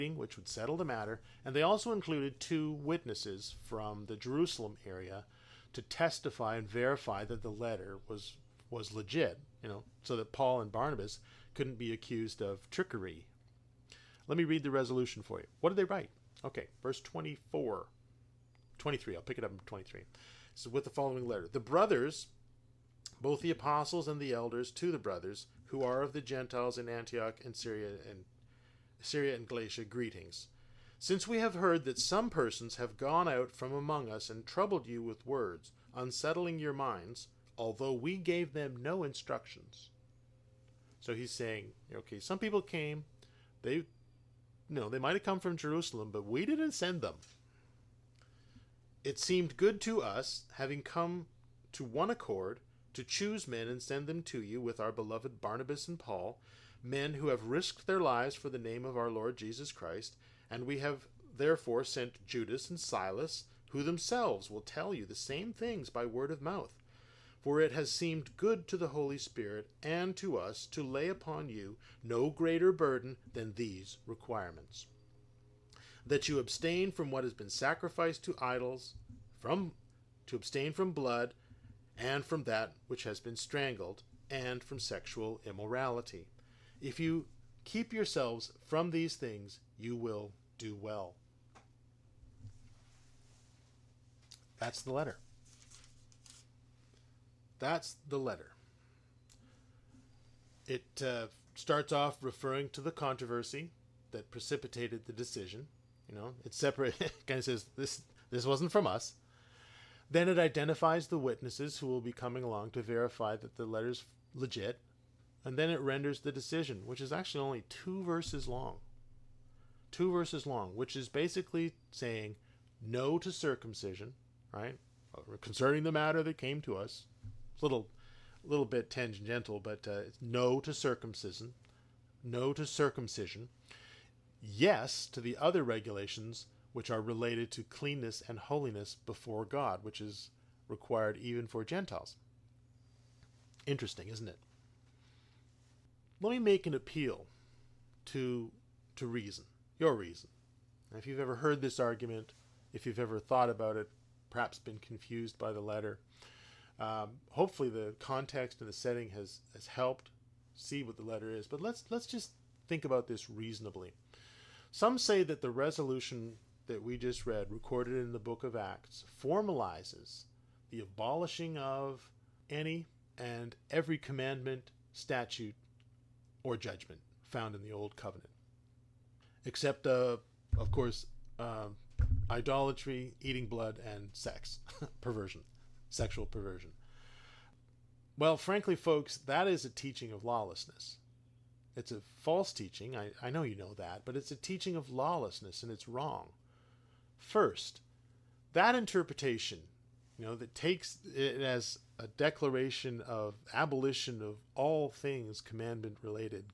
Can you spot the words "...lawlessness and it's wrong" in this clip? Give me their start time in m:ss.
3:14.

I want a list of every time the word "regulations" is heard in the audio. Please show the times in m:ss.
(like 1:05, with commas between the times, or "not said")
2:15.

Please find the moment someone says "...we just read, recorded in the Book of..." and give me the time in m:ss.
2:46.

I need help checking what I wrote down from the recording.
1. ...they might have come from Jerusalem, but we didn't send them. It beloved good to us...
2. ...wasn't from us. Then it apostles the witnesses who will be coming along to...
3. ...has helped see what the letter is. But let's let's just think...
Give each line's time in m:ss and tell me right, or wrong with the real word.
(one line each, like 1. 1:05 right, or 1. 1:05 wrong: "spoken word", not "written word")
1. 0:44 wrong: "seemed", not "beloved"
2. 1:48 wrong: "identifies", not "apostles"
3. 2:39 right.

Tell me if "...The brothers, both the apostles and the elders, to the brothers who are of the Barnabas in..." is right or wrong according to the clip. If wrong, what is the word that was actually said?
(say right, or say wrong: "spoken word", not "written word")
wrong: "Gentiles", not "Barnabas".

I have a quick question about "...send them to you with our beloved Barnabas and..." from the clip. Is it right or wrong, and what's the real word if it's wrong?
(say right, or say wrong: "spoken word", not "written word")
right.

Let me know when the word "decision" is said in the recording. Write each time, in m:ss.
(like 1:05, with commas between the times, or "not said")
1:45, 1:56.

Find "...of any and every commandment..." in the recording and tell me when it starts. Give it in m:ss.
2:51.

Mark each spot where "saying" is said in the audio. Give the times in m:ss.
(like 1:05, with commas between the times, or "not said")
0:41, 2:01.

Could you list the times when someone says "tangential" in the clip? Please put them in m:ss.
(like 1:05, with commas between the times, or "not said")
2:08.